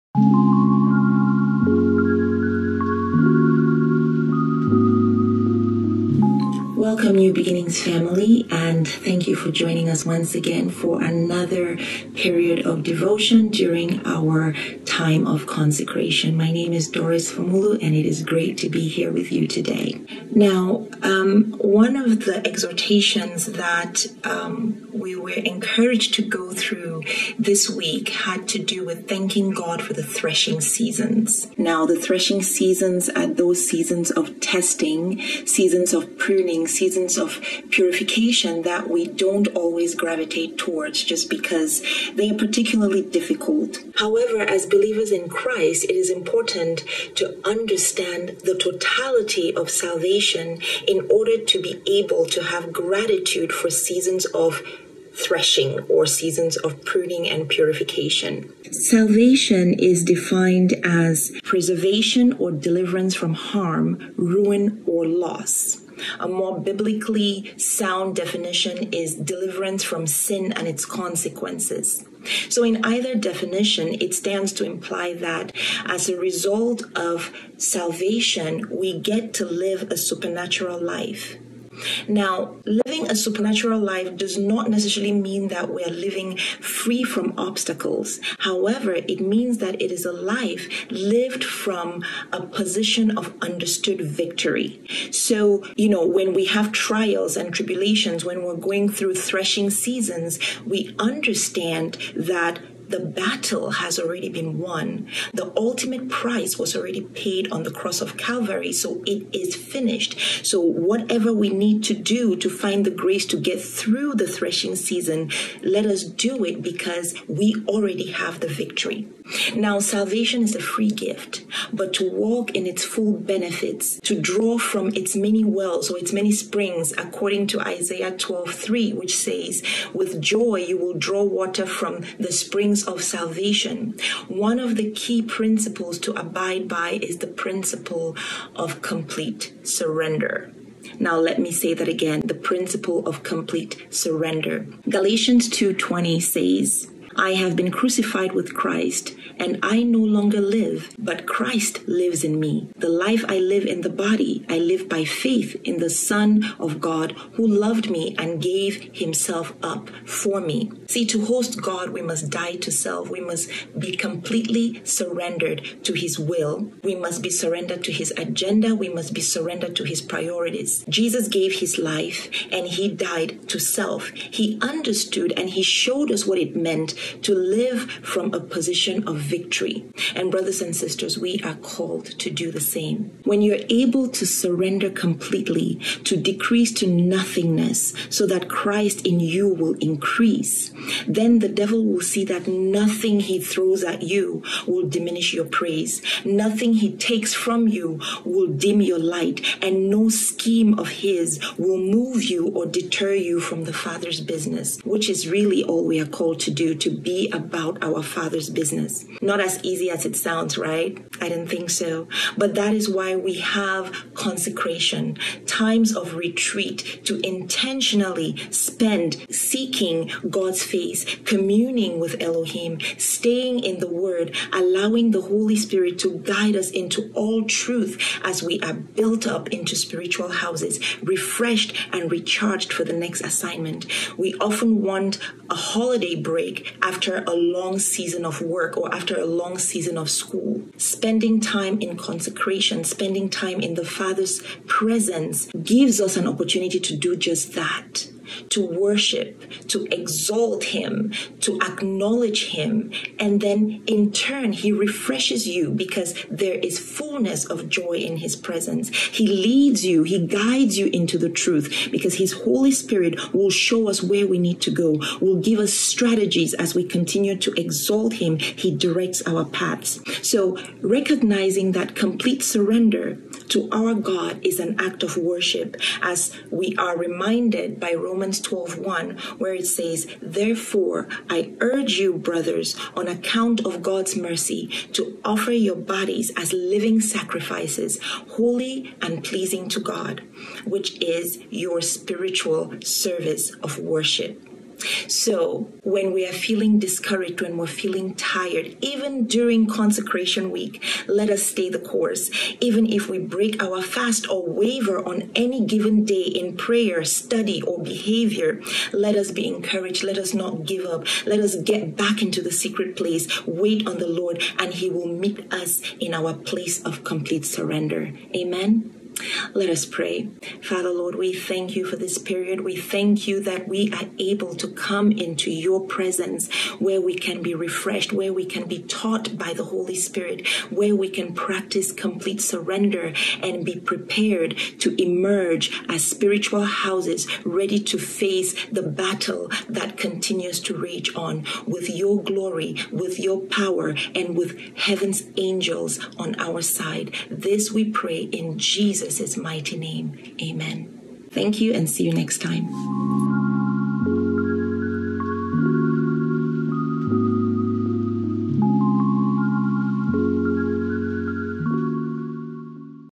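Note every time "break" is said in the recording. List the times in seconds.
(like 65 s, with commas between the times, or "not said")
236 s, 303 s.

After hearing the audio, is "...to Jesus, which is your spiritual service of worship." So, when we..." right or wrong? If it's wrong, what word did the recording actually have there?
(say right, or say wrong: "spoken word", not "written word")
wrong: "God", not "Jesus".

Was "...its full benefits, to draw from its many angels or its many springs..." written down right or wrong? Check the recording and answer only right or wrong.
wrong.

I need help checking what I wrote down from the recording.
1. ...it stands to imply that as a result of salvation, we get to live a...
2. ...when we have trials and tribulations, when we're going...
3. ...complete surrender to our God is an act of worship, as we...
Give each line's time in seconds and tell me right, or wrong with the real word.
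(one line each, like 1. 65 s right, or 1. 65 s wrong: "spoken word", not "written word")
1. 73 s right
2. 96 s right
3. 271 s right.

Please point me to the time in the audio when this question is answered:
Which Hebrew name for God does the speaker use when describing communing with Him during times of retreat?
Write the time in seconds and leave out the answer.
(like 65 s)
222 s.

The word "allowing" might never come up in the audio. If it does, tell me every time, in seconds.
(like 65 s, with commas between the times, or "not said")
224 s.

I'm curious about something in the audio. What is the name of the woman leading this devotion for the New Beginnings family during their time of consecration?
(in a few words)
Doris Formulu.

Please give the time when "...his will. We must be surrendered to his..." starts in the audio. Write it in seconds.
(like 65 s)
165 s.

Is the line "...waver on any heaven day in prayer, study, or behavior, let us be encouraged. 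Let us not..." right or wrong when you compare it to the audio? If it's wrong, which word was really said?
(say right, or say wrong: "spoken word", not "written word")
wrong: "given", not "heaven".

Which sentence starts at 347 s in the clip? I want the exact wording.
This we pray in Jesus' Jesus' mighty name.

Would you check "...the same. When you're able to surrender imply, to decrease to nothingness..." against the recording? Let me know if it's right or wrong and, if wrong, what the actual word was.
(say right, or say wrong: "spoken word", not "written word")
wrong: "completely", not "imply".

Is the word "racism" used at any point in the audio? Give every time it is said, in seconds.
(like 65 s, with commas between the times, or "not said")
not said.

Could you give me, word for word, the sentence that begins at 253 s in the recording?
And then in turn, He refreshes you because there is fullness of joy in His presence.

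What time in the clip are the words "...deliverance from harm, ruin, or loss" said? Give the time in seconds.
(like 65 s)
62 s.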